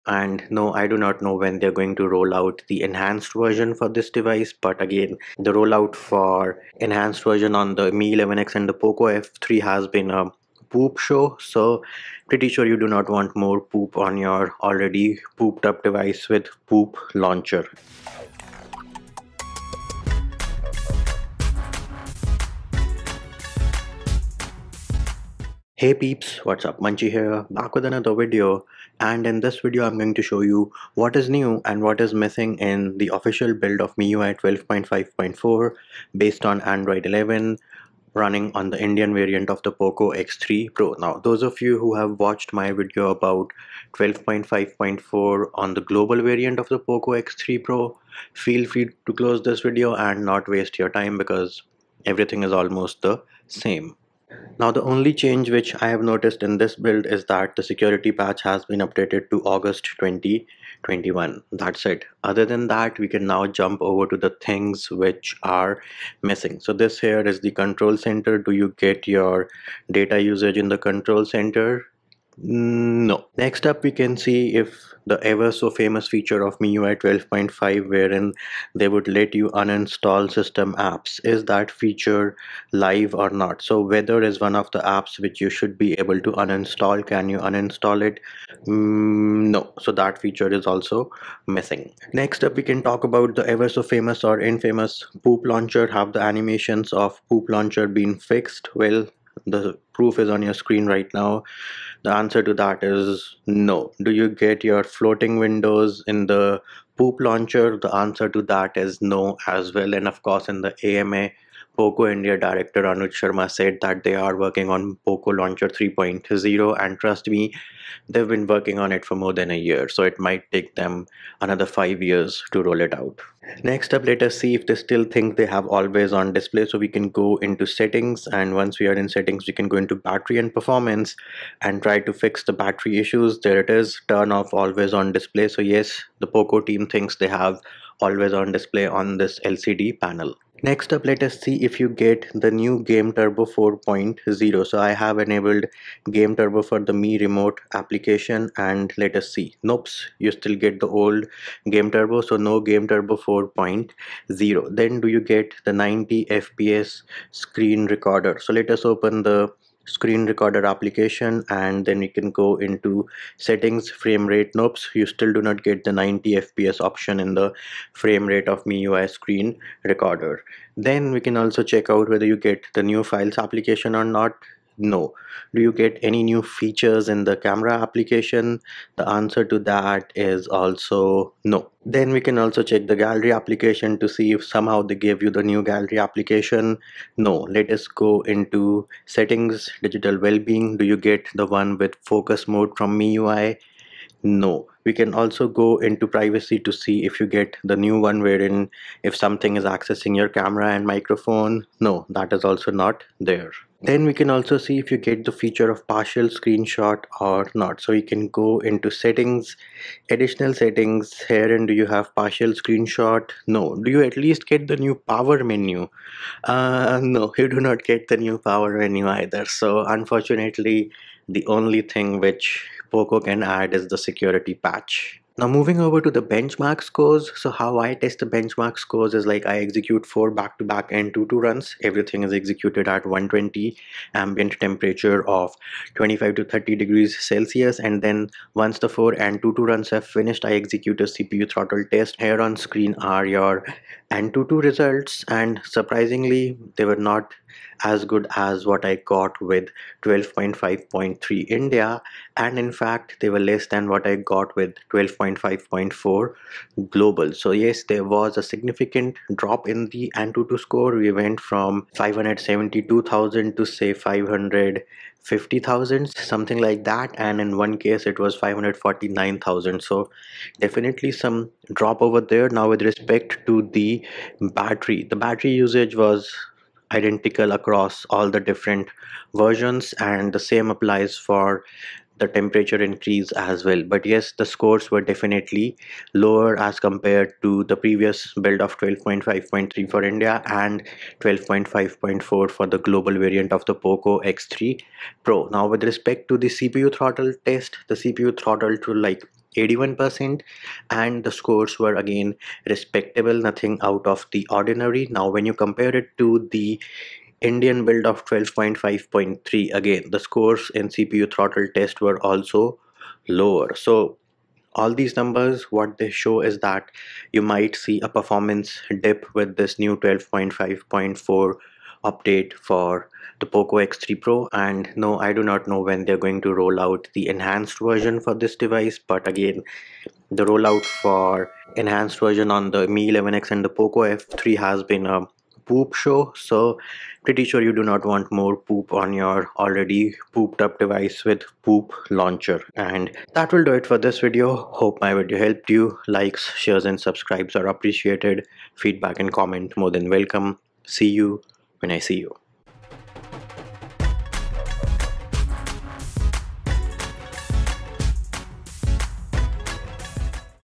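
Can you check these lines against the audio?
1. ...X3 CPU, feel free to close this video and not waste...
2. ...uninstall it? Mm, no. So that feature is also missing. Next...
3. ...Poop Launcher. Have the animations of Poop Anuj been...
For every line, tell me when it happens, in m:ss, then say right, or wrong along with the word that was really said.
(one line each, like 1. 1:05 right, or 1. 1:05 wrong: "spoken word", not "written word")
1. 0:47 wrong: "Pro", not "CPU"
2. 1:27 right
3. 1:35 wrong: "Launcher", not "Anuj".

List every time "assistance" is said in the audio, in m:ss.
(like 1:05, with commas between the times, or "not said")
not said.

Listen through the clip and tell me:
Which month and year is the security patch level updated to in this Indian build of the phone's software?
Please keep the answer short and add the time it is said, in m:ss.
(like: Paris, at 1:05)
August 2021, at 0:59.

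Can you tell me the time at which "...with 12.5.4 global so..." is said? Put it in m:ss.
4:14.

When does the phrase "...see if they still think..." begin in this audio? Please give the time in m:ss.
2:04.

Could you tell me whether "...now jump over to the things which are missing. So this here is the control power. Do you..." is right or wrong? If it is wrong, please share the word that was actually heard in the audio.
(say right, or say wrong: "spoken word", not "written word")
wrong: "center", not "power".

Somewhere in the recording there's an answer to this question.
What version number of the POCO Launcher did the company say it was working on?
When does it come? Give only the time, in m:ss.
1:55.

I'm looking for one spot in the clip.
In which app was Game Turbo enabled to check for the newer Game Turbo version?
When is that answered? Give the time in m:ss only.
2:26.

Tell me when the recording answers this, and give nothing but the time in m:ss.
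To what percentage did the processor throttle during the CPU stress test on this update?
4:59.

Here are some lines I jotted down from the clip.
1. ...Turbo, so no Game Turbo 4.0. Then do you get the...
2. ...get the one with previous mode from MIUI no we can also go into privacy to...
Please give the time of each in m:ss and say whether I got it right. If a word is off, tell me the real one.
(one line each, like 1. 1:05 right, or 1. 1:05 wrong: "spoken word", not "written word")
1. 2:31 right
2. 3:10 wrong: "focus", not "previous".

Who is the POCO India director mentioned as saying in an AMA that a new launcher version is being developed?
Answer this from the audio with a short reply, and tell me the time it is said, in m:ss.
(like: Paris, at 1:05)
Anuj Sharma, at 1:52.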